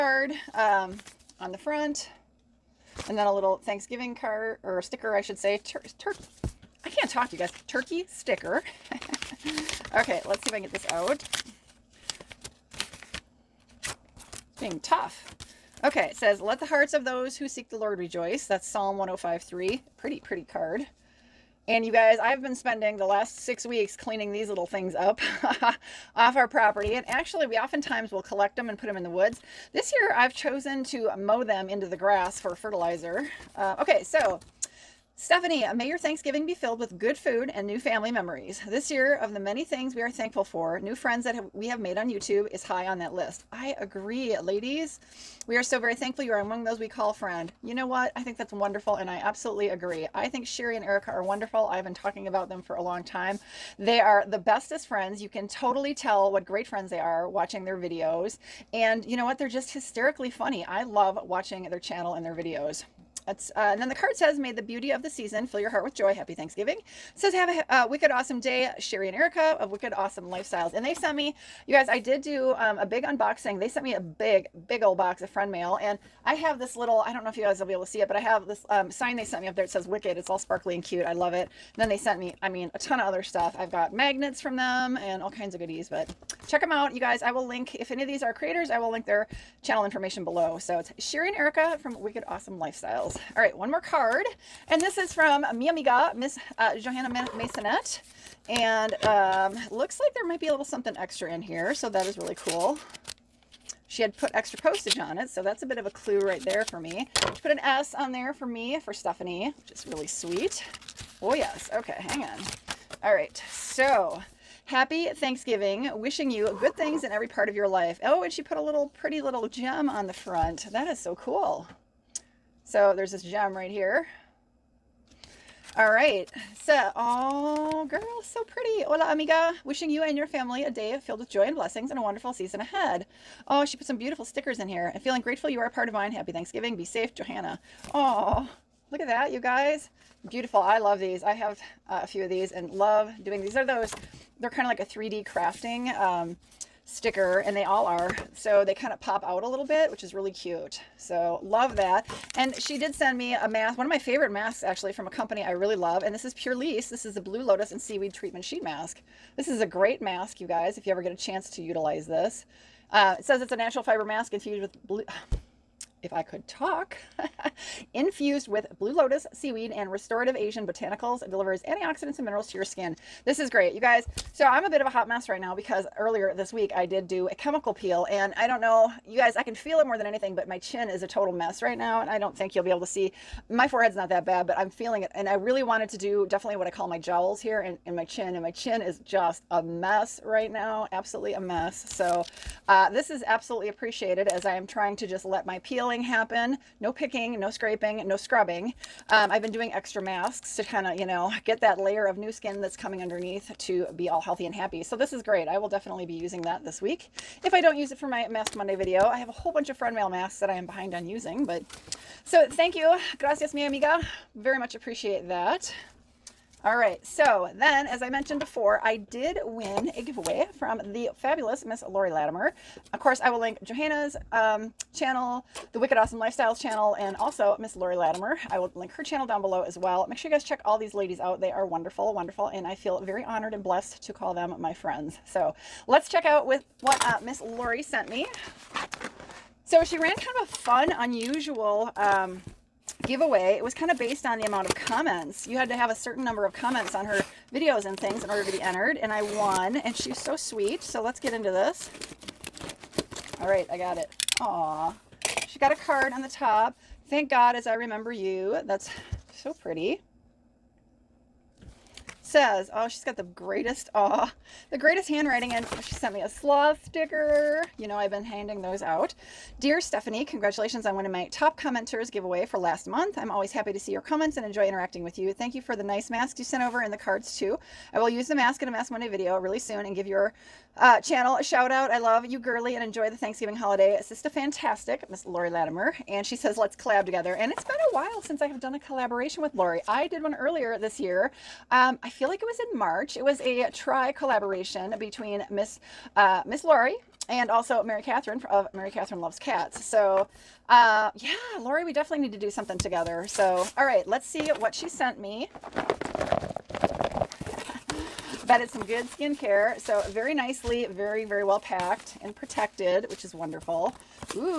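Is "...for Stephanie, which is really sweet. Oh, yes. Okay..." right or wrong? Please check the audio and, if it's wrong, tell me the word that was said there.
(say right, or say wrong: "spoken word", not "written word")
right.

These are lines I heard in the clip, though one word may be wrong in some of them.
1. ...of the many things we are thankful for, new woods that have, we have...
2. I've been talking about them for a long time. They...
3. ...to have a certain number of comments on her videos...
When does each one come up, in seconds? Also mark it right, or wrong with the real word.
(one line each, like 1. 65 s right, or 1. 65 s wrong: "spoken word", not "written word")
1. 39 s wrong: "friends", not "woods"
2. 51 s right
3. 245 s right.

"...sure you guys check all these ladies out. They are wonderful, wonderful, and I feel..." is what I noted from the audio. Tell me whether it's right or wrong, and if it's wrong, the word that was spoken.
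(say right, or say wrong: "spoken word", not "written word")
right.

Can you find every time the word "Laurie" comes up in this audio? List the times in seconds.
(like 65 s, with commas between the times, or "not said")
221 s, 227 s, 237 s, 285 s, 289 s, 296 s, 301 s.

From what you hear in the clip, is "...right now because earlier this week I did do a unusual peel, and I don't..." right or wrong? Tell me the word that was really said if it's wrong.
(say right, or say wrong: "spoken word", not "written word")
wrong: "chemical", not "unusual".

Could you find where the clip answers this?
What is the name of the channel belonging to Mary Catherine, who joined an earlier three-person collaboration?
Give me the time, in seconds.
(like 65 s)
298 s.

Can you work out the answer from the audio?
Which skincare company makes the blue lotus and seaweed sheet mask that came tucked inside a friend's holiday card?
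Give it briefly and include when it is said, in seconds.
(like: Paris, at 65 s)
Purlisse, at 156 s.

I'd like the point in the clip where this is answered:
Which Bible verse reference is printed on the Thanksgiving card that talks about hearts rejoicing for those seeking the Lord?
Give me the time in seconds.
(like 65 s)
18 s.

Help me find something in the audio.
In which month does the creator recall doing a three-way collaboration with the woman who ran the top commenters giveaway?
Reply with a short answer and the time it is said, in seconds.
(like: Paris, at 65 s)
March, at 292 s.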